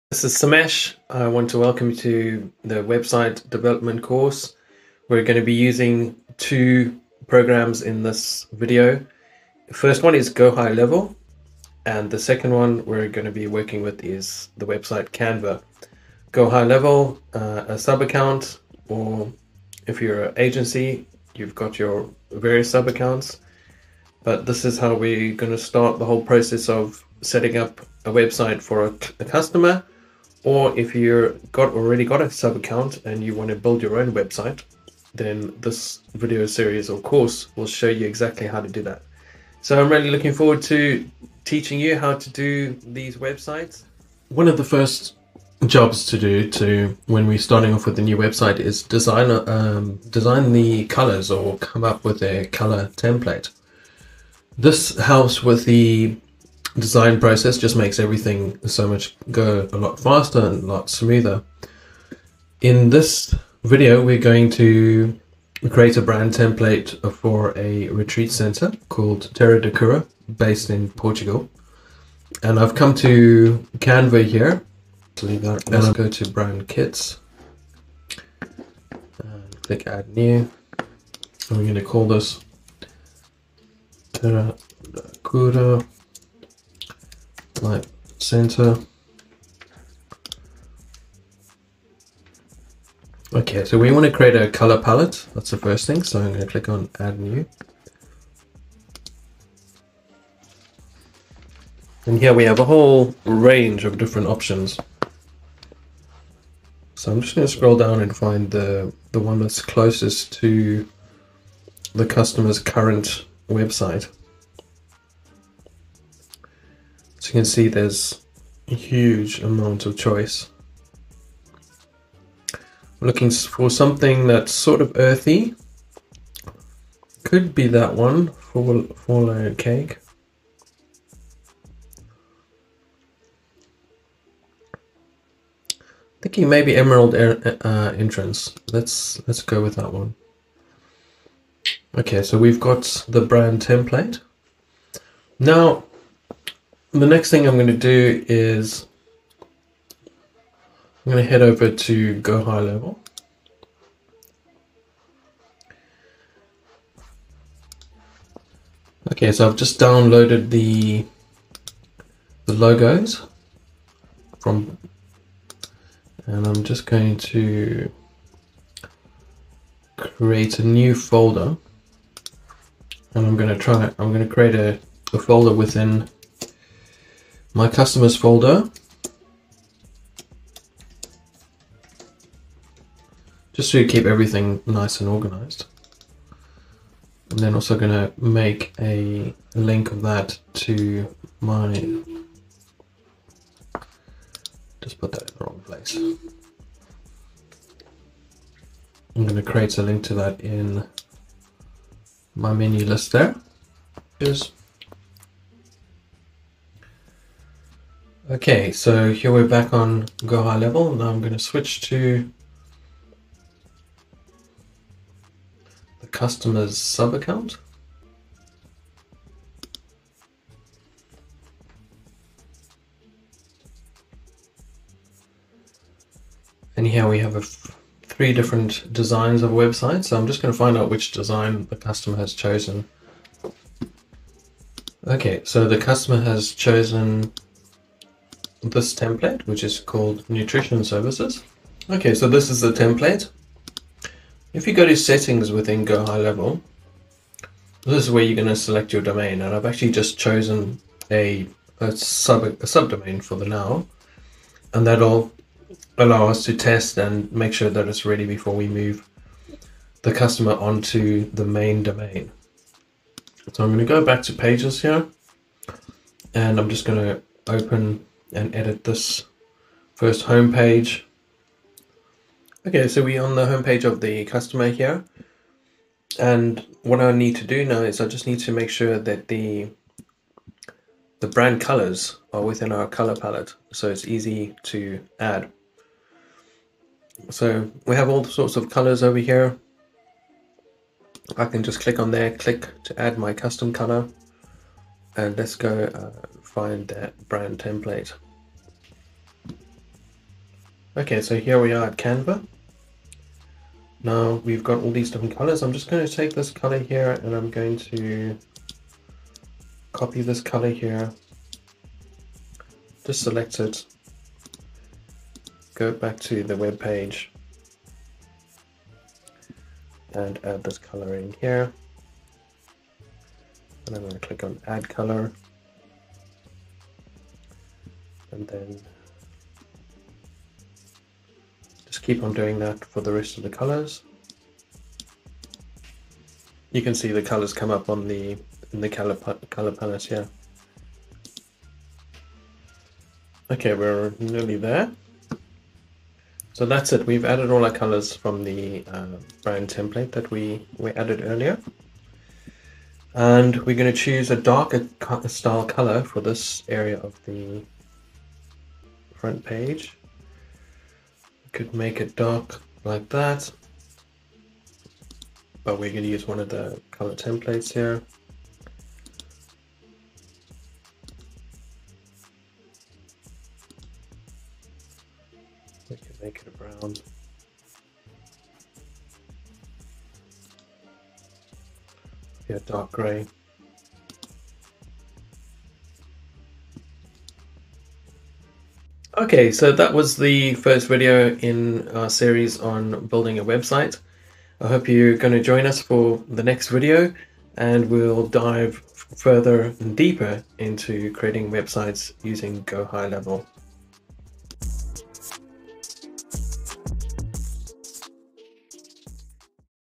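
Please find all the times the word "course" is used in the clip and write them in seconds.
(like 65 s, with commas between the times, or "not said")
4 s, 37 s.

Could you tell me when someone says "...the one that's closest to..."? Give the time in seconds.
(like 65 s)
109 s.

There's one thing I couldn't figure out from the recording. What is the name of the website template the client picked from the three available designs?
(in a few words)
Nutrition Services.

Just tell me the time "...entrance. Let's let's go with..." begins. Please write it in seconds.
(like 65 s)
137 s.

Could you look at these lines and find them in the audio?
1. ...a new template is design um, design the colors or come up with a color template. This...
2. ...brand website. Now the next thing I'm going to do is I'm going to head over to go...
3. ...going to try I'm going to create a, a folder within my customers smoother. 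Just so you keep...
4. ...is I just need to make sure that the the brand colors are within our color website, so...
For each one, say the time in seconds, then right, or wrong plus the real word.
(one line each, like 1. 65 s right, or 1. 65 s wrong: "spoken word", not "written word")
1. 47 s wrong: "website", not "template"
2. 143 s wrong: "template", not "website"
3. 173 s wrong: "folder", not "smoother"
4. 277 s wrong: "palette", not "website".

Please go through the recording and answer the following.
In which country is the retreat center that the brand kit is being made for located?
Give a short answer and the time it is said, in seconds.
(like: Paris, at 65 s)
Portugal, at 70 s.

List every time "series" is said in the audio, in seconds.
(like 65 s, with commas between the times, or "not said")
36 s, 392 s.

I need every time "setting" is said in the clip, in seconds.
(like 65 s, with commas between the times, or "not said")
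27 s, 244 s.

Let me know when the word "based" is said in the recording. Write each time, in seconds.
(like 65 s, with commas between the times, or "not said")
70 s.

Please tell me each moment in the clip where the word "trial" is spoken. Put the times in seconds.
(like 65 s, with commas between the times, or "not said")
not said.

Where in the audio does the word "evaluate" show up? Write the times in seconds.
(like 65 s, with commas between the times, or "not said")
not said.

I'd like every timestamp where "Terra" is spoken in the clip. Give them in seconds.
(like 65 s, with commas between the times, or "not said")
69 s, 84 s.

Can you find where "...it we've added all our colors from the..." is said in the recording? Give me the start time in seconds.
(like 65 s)
346 s.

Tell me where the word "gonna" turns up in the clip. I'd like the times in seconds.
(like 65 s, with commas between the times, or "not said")
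187 s, 199 s.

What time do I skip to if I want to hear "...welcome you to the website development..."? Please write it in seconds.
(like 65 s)
1 s.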